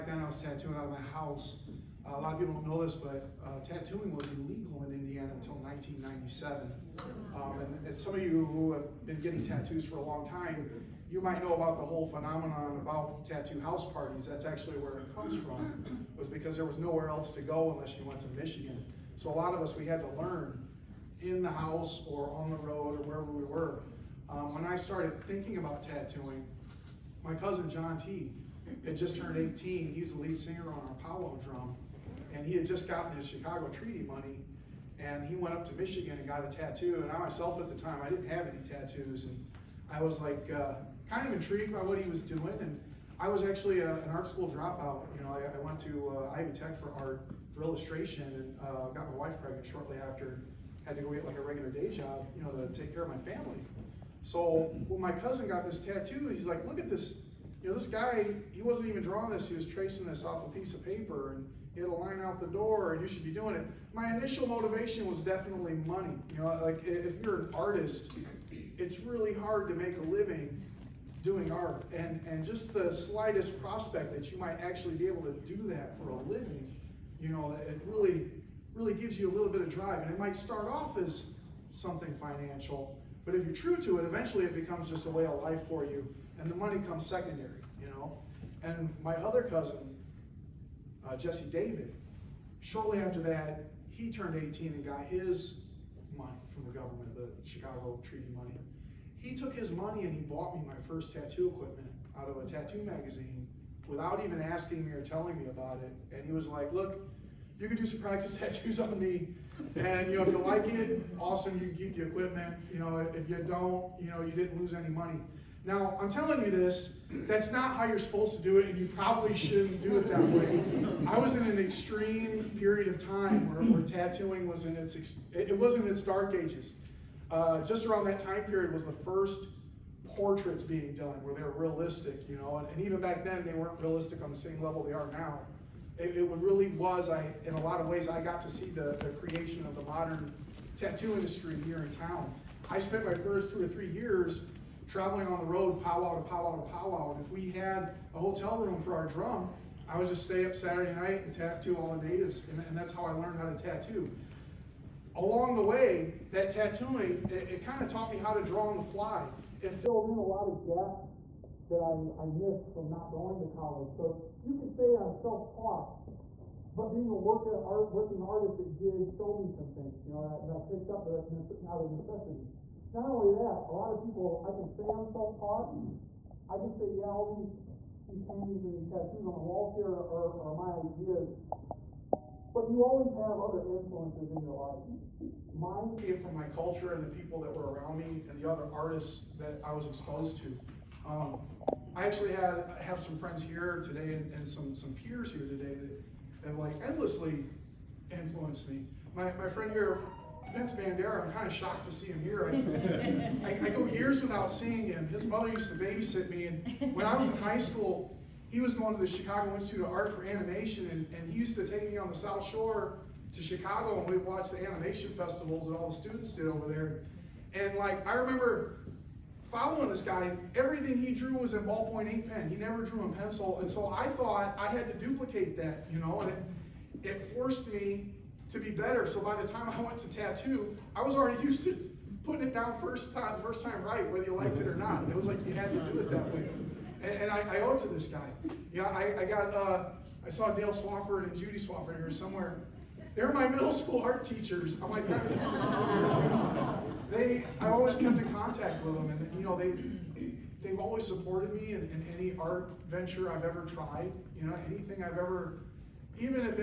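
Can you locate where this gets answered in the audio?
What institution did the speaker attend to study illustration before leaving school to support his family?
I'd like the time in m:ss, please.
0:46.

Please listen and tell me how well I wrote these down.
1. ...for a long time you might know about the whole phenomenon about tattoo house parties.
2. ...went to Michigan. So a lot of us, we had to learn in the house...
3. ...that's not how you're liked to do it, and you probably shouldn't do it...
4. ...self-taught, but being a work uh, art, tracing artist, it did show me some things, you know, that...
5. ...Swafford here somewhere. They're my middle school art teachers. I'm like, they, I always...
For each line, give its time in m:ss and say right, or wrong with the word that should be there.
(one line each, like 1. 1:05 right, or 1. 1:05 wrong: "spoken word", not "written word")
1. 0:09 right
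2. 0:18 right
3. 1:57 wrong: "supposed", not "liked"
4. 2:45 wrong: "working", not "tracing"
5. 4:01 right.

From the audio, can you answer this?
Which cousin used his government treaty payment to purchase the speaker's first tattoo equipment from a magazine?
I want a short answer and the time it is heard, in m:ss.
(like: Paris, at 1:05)
Jesse David, at 1:31.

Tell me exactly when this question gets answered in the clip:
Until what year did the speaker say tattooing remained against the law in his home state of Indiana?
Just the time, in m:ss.
0:05.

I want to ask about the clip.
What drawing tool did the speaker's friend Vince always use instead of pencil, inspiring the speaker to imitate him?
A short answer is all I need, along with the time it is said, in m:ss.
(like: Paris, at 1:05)
ballpoint ink pen, at 3:41.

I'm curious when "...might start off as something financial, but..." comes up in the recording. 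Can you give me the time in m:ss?
1:20.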